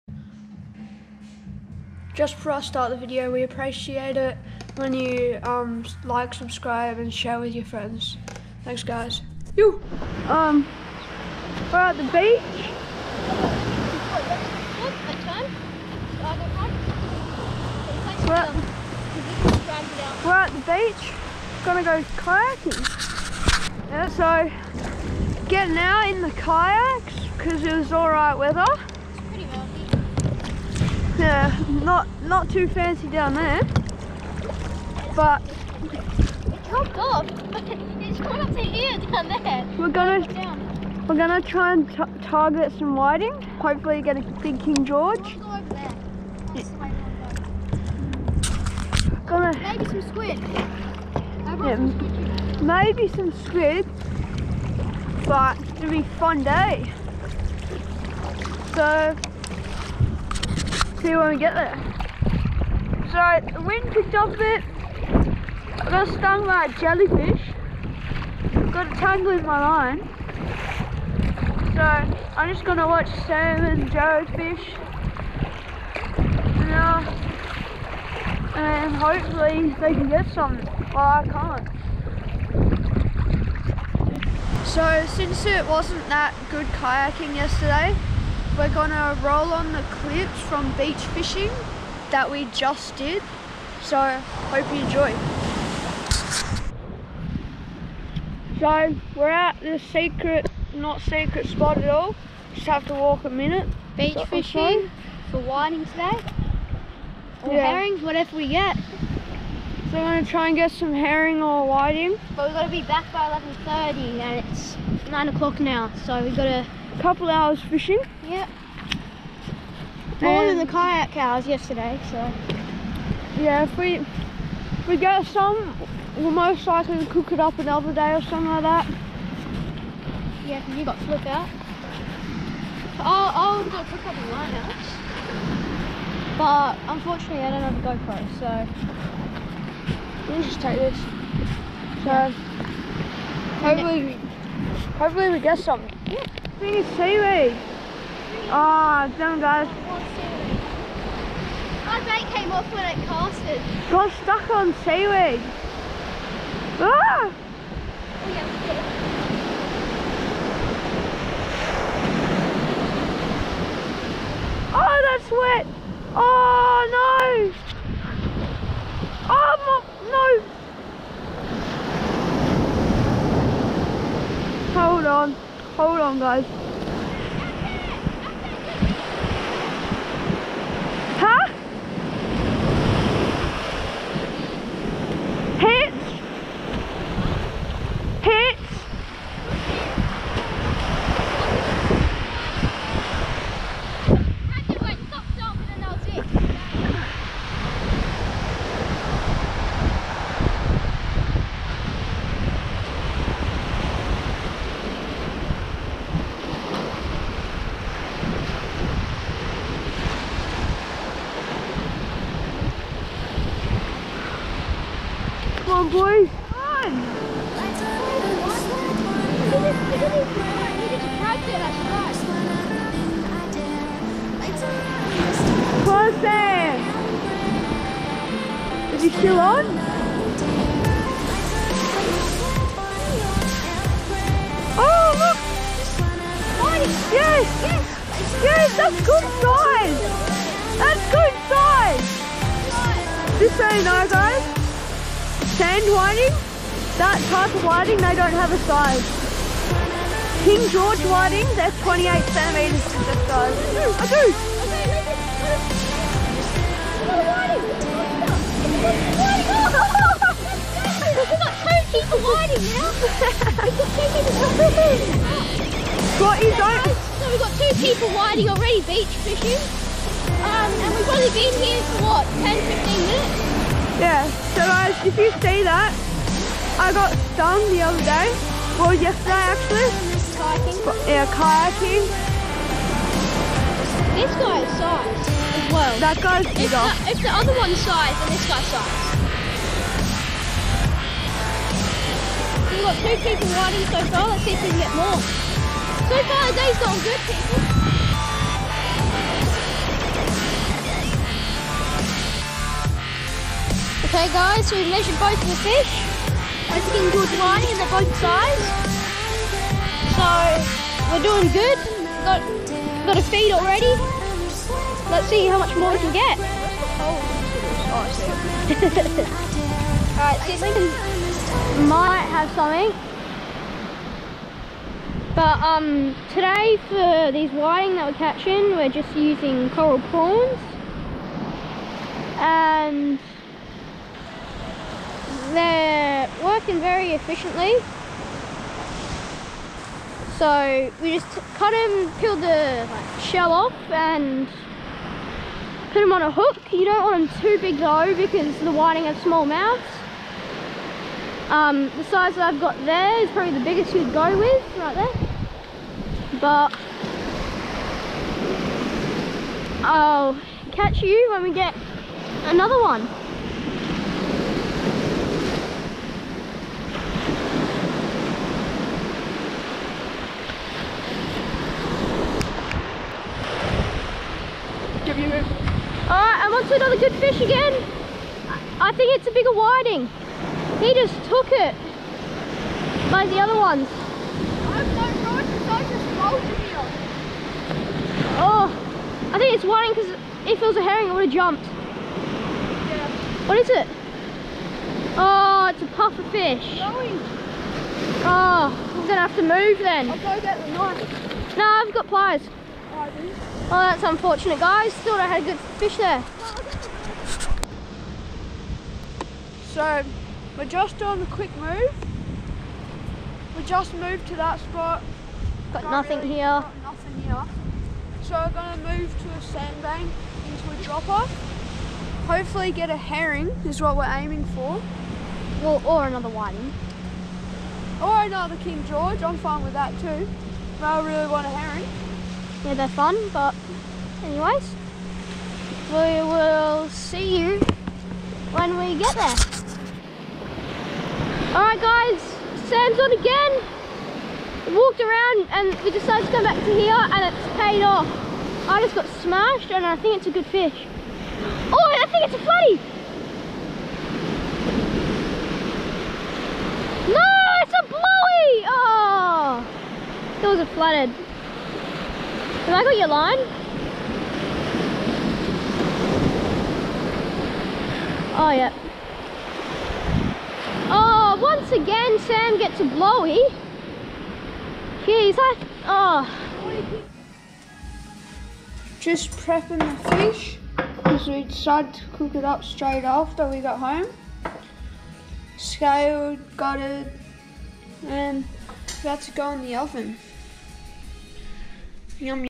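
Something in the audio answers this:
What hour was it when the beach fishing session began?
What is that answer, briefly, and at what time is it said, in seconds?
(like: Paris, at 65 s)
9 o'clock, at 115 s.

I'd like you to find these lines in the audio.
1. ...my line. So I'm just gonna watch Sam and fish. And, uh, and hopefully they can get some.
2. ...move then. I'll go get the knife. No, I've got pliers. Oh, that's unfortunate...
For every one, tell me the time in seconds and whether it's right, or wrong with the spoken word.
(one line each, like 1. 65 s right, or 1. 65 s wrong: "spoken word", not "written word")
1. 69 s right
2. 399 s right.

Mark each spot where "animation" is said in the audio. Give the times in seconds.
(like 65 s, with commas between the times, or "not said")
not said.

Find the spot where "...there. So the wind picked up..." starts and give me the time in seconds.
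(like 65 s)
61 s.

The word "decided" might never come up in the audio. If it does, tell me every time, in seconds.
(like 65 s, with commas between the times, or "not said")
445 s, 481 s.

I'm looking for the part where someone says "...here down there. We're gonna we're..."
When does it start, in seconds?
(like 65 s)
38 s.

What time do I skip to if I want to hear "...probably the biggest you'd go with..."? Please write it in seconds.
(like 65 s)
353 s.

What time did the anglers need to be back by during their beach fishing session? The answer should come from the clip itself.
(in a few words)
11:30.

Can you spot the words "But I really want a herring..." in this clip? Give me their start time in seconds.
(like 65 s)
430 s.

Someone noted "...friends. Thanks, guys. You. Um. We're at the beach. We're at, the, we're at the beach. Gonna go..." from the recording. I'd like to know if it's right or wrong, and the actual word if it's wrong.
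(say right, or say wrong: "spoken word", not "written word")
right.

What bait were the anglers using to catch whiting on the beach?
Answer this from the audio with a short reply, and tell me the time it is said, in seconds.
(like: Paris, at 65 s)
coral prawns, at 329 s.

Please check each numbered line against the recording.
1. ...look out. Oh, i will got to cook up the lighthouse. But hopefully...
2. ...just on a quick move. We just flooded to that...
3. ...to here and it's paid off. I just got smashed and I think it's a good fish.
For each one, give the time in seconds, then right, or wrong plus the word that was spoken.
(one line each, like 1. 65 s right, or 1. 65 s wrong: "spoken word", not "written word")
1. 131 s wrong: "unfortunately", not "hopefully"
2. 410 s wrong: "moved", not "flooded"
3. 446 s right.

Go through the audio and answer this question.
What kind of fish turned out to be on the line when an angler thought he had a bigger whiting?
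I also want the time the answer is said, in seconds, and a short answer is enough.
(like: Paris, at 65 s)
puffer fish, at 395 s.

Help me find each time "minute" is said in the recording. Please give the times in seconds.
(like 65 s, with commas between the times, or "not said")
103 s, 273 s.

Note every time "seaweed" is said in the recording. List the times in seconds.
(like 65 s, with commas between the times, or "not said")
146 s, 154 s.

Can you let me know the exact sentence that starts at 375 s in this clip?
Alright, I'm onto another good fish again.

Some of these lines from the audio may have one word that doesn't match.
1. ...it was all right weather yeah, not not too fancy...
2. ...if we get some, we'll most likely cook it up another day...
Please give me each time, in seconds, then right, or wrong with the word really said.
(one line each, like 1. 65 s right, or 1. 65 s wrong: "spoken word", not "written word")
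1. 27 s right
2. 123 s right.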